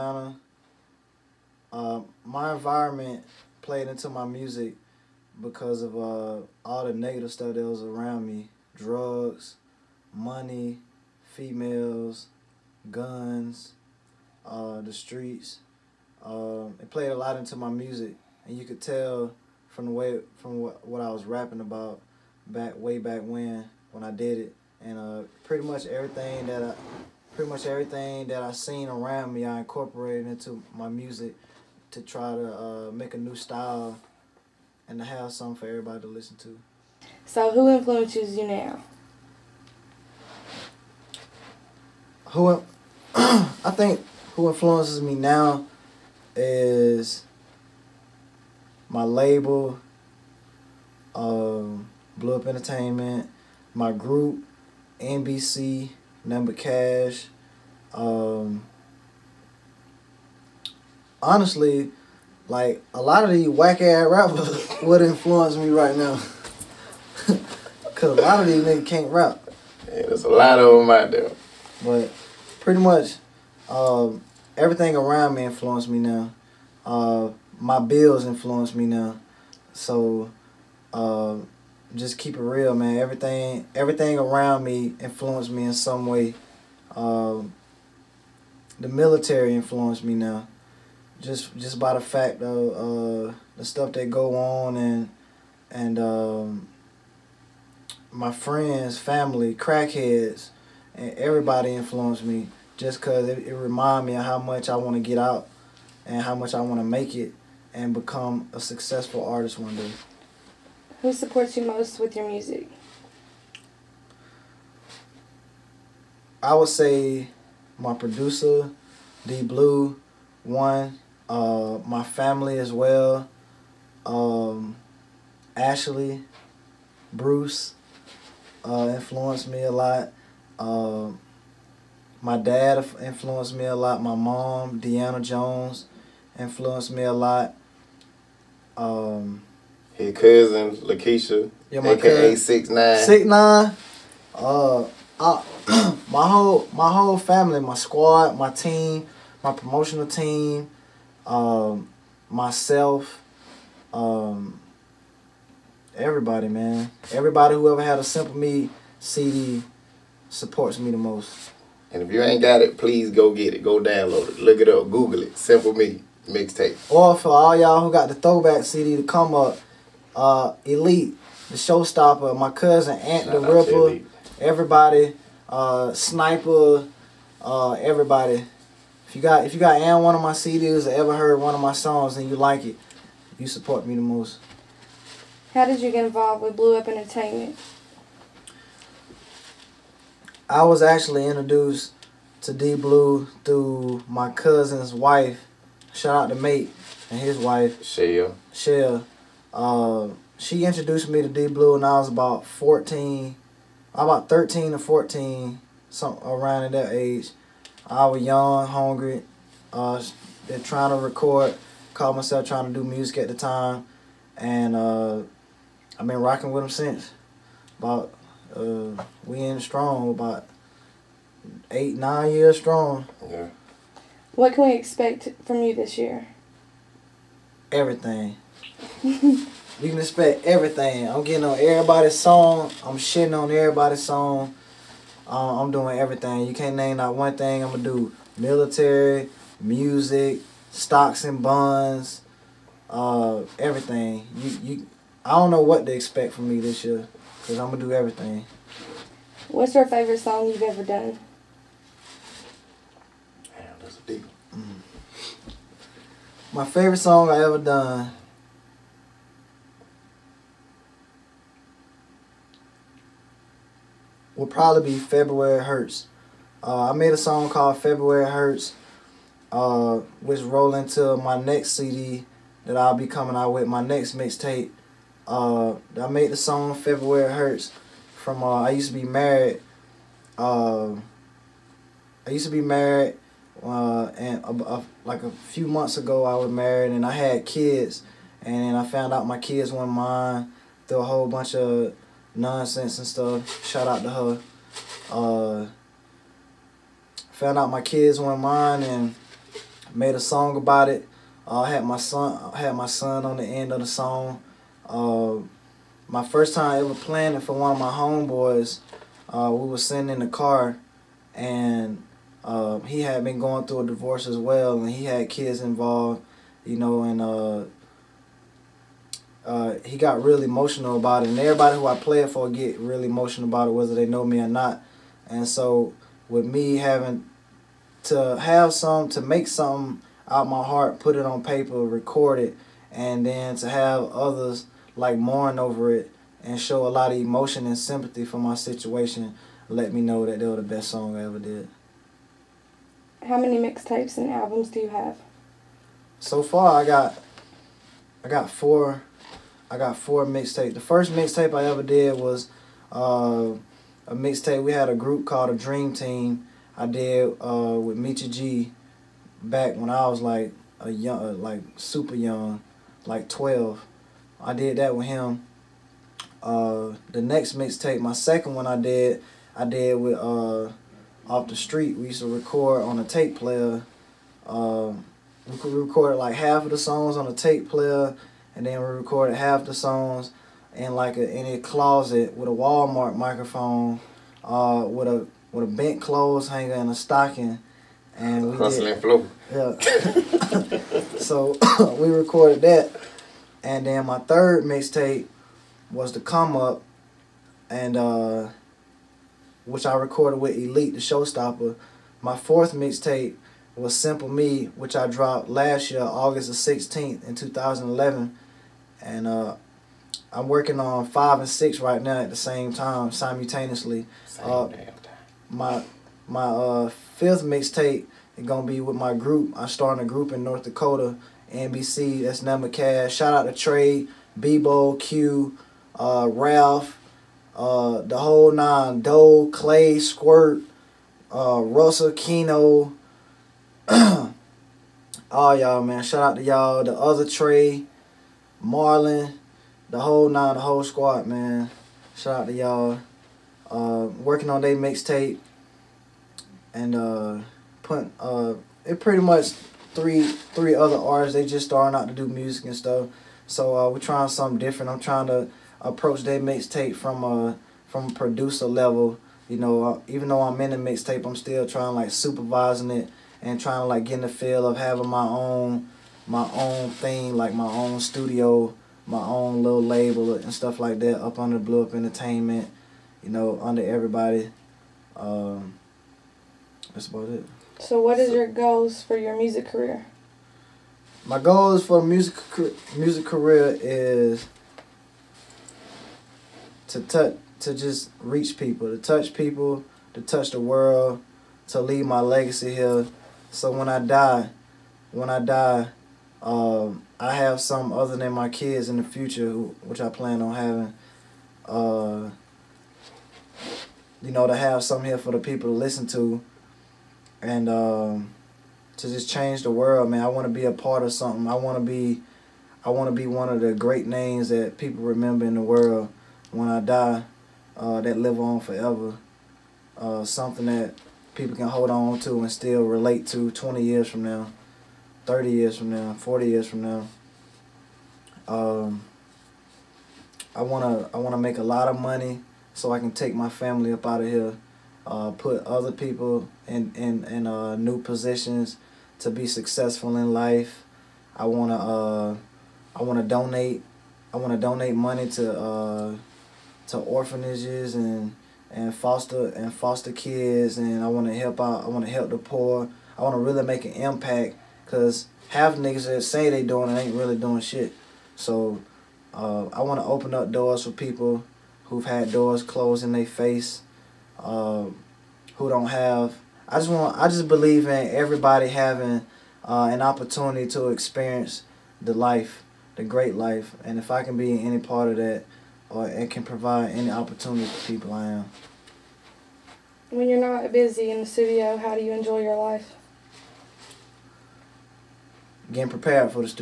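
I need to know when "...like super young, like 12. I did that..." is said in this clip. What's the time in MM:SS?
06:01.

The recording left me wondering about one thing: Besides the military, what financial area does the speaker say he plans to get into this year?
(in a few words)
stocks and bonds.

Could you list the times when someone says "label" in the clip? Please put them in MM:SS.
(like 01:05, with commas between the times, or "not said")
00:49, 07:49.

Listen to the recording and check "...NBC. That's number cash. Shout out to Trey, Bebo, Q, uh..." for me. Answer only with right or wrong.
right.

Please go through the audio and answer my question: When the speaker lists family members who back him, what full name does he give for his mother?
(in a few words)
Deanna Jones.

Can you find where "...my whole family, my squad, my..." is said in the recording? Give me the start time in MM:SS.
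02:26.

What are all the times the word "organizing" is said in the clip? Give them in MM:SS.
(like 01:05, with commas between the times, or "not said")
not said.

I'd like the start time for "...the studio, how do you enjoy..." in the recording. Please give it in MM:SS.
09:41.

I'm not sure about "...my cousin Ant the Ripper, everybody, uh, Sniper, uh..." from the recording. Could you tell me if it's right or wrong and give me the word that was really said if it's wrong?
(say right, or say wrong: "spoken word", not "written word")
right.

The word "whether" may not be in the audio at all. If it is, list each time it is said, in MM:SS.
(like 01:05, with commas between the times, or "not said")
05:23.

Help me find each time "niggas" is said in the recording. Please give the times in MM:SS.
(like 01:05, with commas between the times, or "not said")
01:08, 09:15.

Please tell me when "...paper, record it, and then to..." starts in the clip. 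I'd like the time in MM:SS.
05:31.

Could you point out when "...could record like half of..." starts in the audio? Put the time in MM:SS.
06:15.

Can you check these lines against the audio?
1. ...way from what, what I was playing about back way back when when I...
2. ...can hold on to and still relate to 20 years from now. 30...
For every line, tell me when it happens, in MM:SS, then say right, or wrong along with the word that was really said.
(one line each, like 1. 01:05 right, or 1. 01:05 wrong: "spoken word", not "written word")
1. 00:19 wrong: "rapping", not "playing"
2. 08:41 right.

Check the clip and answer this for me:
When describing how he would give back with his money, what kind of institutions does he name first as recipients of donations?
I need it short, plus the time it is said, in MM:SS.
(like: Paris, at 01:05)
orphanages, at 09:06.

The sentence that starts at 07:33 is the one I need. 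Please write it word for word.
So uh, we're trying something different.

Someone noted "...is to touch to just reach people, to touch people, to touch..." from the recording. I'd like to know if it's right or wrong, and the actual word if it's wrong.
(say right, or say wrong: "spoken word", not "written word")
right.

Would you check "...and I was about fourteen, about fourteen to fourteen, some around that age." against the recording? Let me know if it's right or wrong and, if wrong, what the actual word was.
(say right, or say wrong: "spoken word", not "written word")
wrong: "thirteen", not "fourteen".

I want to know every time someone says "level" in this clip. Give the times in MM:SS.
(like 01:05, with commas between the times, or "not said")
07:38.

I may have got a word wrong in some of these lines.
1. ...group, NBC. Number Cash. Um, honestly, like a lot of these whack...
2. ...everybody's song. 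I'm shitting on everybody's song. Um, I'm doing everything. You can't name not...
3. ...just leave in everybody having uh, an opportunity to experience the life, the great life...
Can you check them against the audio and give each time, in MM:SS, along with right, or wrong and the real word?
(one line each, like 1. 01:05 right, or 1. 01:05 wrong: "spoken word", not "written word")
1. 00:53 right
2. 03:51 right
3. 09:27 wrong: "believe", not "leave".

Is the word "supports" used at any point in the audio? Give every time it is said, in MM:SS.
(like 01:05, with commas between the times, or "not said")
01:51, 02:40, 03:03.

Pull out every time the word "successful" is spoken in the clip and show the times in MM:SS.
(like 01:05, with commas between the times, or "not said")
01:48, 08:59.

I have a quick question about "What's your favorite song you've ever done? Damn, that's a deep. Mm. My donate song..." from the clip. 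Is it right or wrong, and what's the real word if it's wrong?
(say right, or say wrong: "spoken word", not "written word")
wrong: "favorite", not "donate".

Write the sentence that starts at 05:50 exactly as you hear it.
The first mixtape I ever did was uh, a mixtape.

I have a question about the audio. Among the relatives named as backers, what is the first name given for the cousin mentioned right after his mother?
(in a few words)
Lakeisha.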